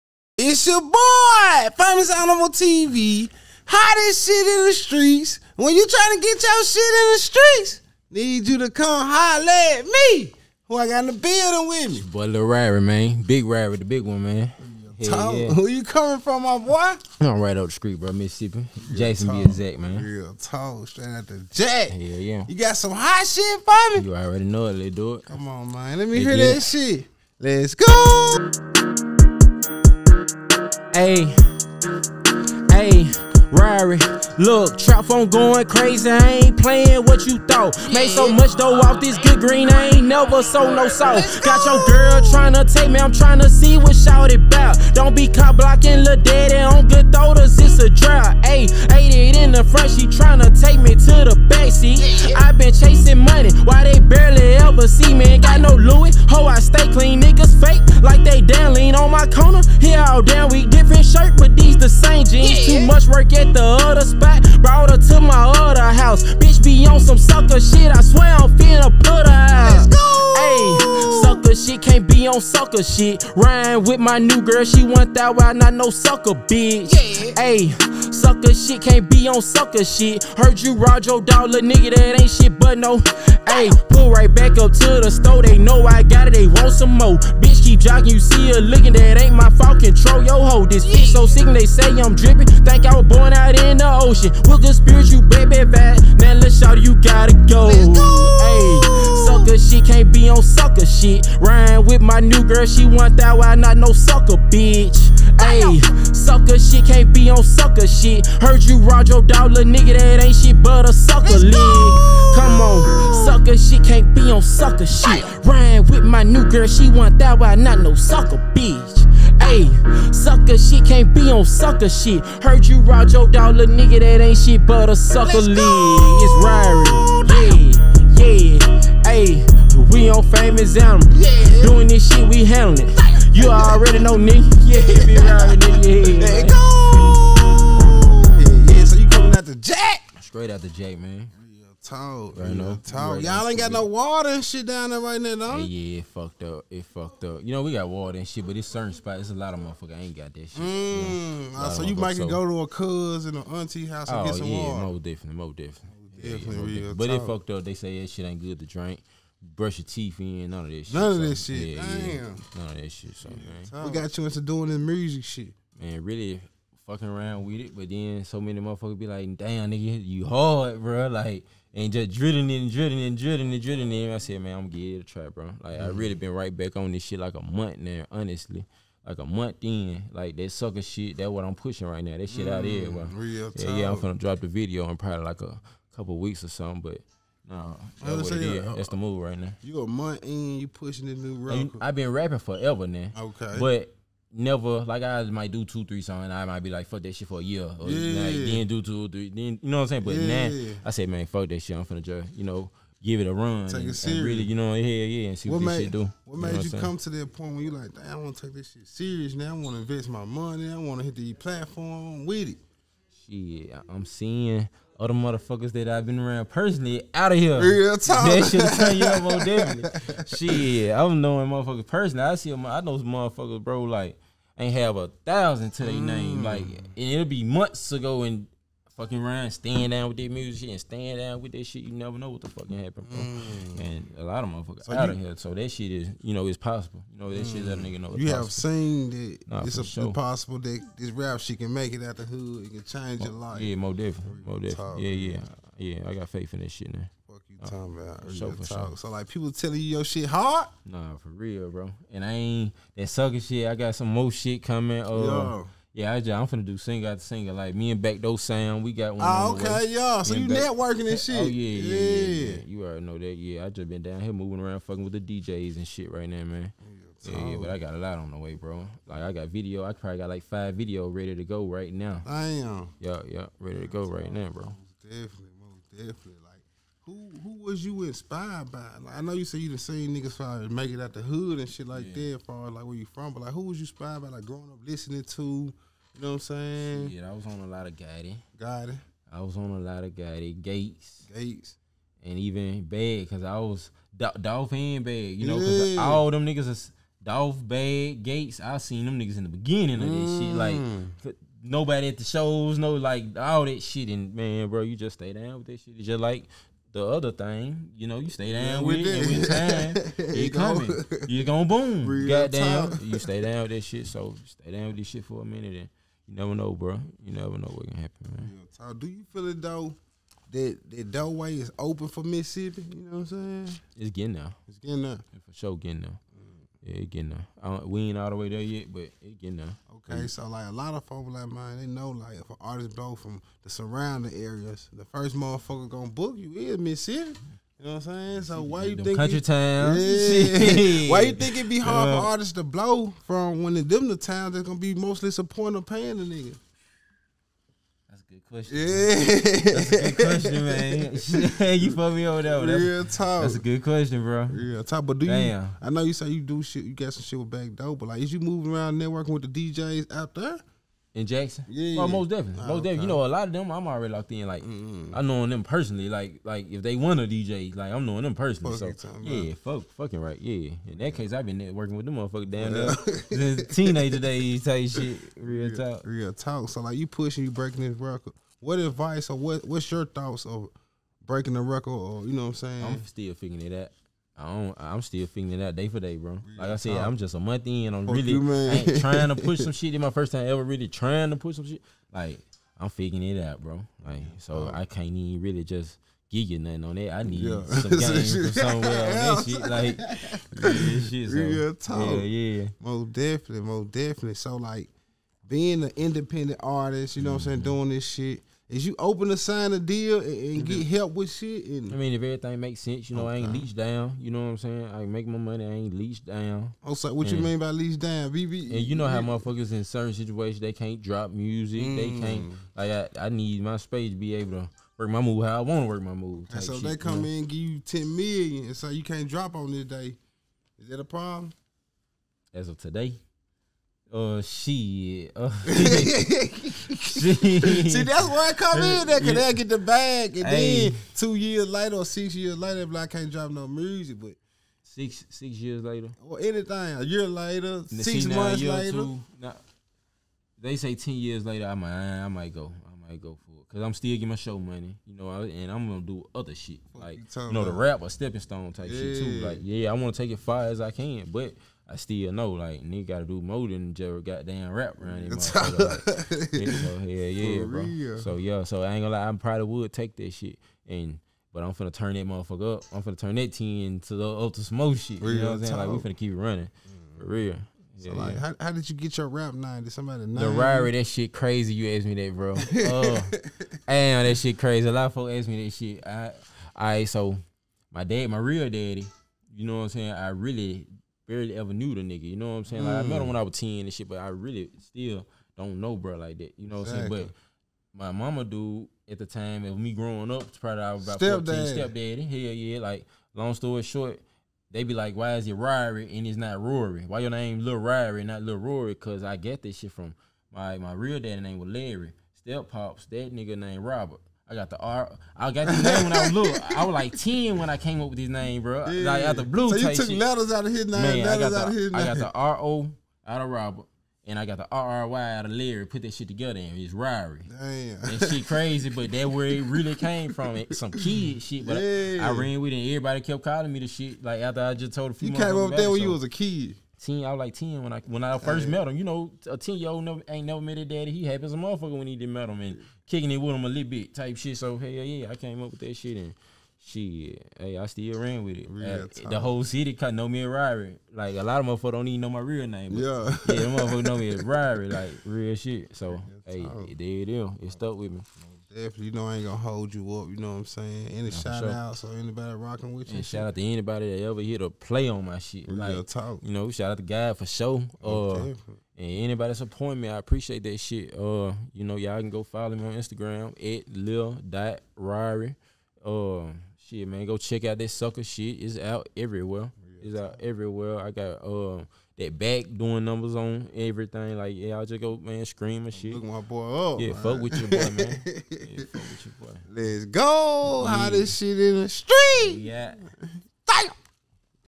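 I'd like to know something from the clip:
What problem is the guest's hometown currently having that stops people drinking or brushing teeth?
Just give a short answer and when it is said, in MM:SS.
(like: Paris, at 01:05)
No water, at 02:23.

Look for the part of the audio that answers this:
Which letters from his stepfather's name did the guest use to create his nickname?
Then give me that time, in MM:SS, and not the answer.
08:42.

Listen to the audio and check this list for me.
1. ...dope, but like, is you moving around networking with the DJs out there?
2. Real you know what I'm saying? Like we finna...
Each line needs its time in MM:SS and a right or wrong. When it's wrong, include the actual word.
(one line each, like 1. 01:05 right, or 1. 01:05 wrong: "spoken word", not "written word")
1. 05:57 right
2. 07:55 right.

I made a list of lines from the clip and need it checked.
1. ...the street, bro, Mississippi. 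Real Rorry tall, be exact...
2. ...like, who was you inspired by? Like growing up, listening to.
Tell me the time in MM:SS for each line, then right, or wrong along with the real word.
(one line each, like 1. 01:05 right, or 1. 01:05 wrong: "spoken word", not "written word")
1. 00:17 wrong: "Jackson", not "Rorry"
2. 04:43 right.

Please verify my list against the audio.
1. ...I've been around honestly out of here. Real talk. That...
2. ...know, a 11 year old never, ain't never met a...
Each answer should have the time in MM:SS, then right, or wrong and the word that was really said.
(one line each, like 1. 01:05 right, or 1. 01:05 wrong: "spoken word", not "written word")
1. 03:35 wrong: "personally", not "honestly"
2. 08:59 wrong: "10", not "11".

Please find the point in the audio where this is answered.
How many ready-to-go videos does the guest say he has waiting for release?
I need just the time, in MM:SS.
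04:30.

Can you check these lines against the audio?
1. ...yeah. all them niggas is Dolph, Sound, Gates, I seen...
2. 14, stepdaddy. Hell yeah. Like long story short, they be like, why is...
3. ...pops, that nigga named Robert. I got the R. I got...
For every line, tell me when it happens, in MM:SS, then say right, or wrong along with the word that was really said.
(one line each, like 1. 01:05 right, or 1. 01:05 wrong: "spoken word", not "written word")
1. 04:55 wrong: "Bad", not "Sound"
2. 08:21 right
3. 08:32 right.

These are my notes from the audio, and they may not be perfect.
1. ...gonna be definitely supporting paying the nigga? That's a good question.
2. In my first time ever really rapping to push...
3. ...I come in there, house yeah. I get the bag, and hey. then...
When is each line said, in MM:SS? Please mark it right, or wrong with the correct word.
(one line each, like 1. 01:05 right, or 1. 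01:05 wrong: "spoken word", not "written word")
1. 05:44 wrong: "mostly", not "definitely"
2. 06:29 wrong: "trying", not "rapping"
3. 07:18 wrong: "cause", not "house".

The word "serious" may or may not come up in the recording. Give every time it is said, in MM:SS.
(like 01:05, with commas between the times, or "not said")
03:23, 03:28.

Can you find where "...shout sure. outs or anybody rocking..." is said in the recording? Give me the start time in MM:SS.
09:21.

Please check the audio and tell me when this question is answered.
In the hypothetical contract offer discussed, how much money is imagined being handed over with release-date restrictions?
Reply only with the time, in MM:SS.
07:07.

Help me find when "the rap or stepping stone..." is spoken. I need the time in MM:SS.
07:37.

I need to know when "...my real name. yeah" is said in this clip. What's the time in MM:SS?
09:12.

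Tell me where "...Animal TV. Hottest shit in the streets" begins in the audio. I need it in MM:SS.
00:02.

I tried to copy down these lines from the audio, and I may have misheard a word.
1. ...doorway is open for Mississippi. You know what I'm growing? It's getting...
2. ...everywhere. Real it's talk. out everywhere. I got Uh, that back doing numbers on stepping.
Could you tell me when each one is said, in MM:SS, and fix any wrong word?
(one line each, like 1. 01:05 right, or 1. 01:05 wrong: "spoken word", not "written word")
1. 05:21 wrong: "saying", not "growing"
2. 09:39 wrong: "everything", not "stepping".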